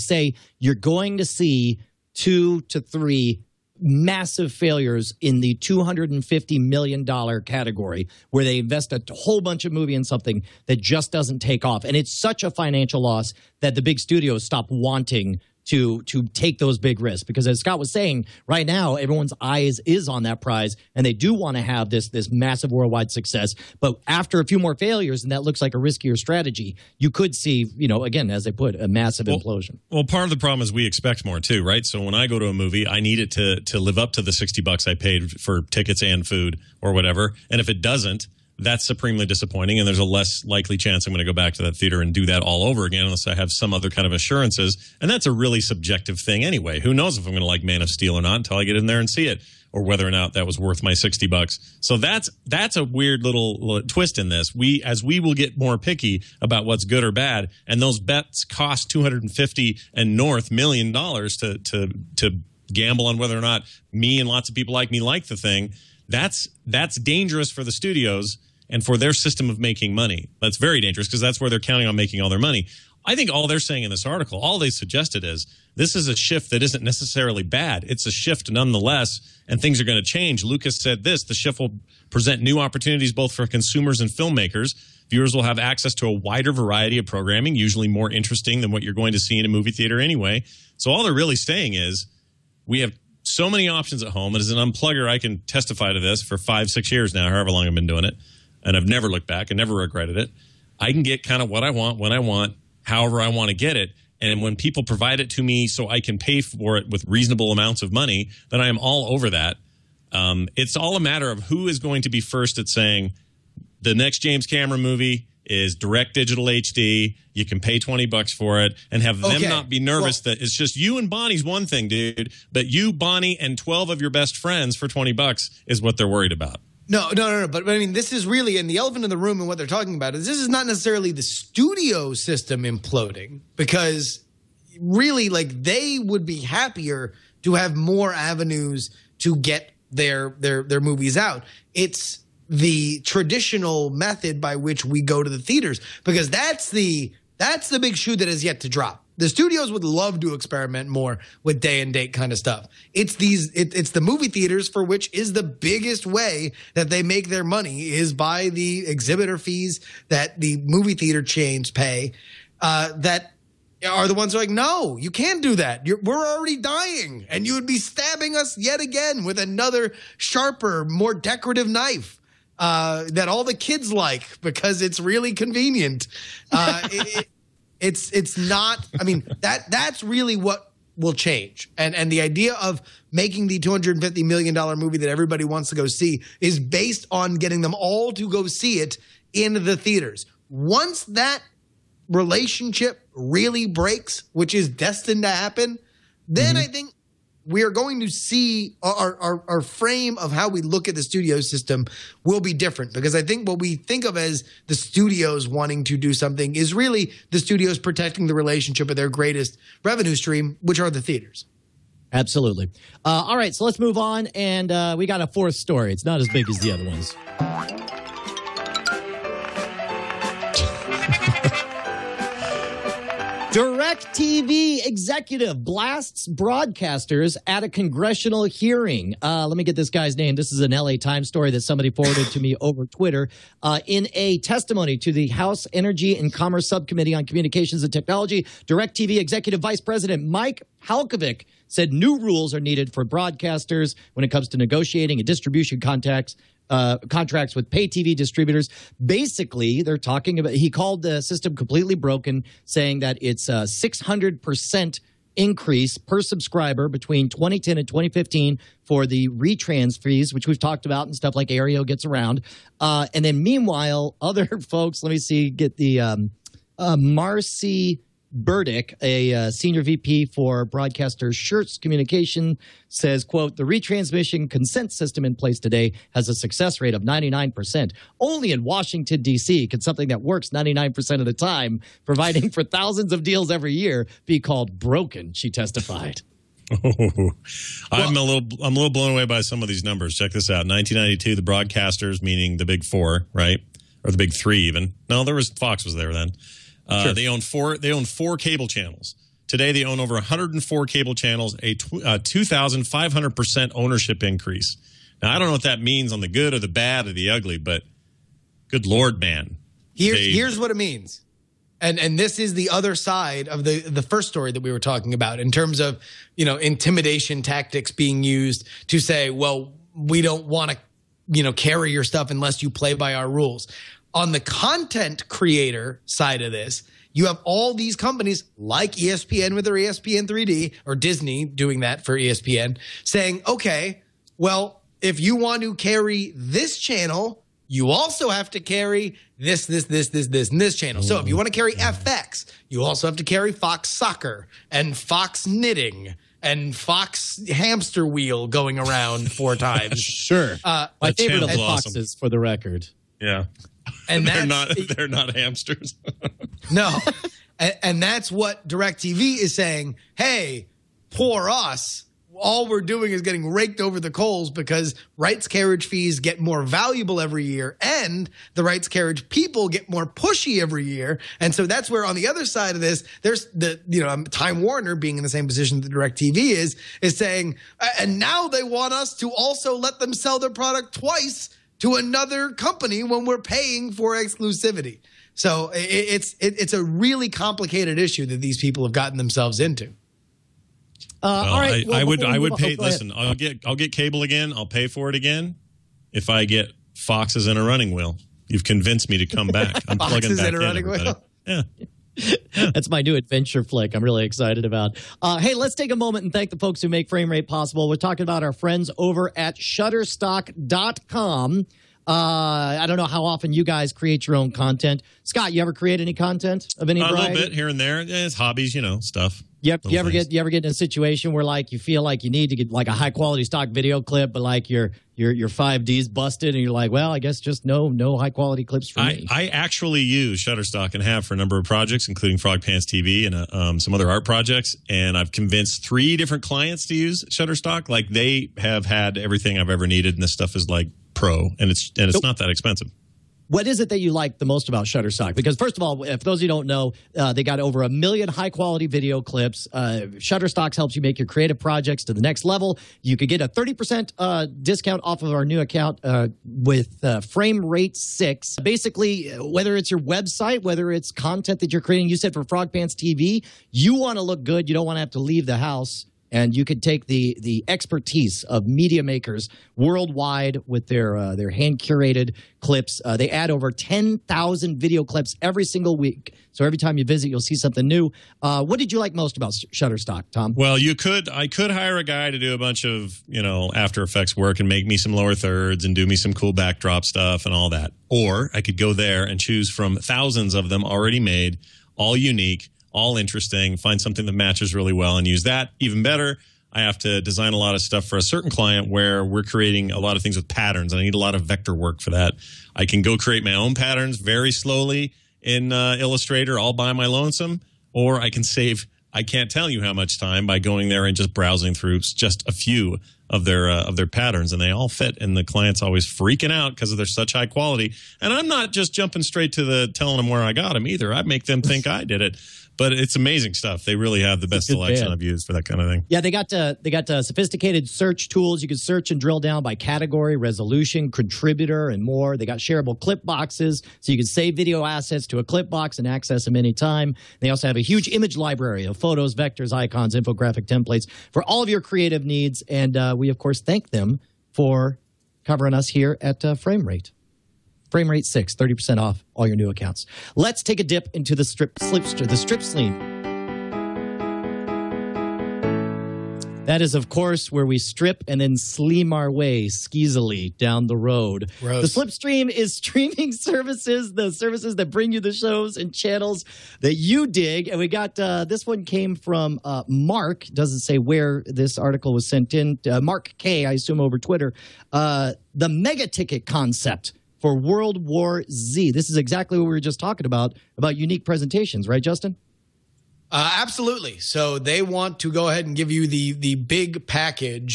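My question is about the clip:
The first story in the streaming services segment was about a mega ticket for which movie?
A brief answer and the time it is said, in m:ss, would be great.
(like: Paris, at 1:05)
World War Z, at 9:37.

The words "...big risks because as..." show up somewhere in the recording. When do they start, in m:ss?
0:16.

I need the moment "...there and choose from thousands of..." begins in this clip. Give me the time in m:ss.
8:08.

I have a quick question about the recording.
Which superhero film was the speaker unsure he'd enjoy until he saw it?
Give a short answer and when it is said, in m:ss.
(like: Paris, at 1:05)
Man of Steel, at 0:47.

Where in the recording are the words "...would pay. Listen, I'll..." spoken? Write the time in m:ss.
6:32.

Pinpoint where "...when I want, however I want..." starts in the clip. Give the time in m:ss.
1:41.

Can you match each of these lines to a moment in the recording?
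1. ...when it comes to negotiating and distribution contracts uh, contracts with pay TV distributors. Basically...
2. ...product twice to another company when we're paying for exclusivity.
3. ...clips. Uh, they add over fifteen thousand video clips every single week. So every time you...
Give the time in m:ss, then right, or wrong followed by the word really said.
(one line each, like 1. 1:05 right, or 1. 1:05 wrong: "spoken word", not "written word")
1. 4:04 right
2. 6:20 right
3. 7:52 wrong: "ten", not "fifteen".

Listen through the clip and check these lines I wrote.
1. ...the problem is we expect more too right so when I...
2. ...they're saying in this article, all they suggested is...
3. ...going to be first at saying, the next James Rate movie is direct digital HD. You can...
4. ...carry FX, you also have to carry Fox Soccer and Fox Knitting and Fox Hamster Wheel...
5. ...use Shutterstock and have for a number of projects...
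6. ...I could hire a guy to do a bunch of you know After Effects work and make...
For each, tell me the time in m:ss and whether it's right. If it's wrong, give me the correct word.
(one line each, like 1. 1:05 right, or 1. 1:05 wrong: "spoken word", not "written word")
1. 0:30 right
2. 1:13 right
3. 1:51 wrong: "Cameron", not "Rate"
4. 5:41 right
5. 7:10 right
6. 8:01 right.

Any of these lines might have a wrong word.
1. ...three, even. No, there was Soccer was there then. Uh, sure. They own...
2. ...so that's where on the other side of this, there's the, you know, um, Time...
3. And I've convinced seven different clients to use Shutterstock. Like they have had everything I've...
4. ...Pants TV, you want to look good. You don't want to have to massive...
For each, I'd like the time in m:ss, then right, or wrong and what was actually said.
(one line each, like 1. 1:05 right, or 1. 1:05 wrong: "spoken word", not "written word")
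1. 4:54 wrong: "Fox", not "Soccer"
2. 6:11 right
3. 7:14 wrong: "three", not "seven"
4. 7:42 wrong: "leave", not "massive".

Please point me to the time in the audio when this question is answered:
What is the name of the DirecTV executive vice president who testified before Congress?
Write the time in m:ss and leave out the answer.
4:00.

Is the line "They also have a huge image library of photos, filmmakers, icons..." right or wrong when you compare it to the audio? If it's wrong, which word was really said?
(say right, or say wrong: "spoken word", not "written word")
wrong: "vectors", not "filmmakers".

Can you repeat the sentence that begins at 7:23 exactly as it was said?
What is it that you like the most about Shutterstock?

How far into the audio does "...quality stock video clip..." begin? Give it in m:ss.
7:03.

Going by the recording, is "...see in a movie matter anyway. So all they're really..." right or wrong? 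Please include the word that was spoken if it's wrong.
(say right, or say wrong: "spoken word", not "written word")
wrong: "theater", not "matter".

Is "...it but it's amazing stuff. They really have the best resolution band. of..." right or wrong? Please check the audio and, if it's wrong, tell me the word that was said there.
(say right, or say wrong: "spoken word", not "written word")
wrong: "selection", not "resolution".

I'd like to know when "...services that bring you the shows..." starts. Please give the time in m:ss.
9:24.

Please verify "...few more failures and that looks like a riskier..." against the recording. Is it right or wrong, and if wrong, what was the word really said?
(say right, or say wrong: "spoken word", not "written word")
right.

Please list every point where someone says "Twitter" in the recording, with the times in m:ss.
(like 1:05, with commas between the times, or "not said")
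3:52, 9:34.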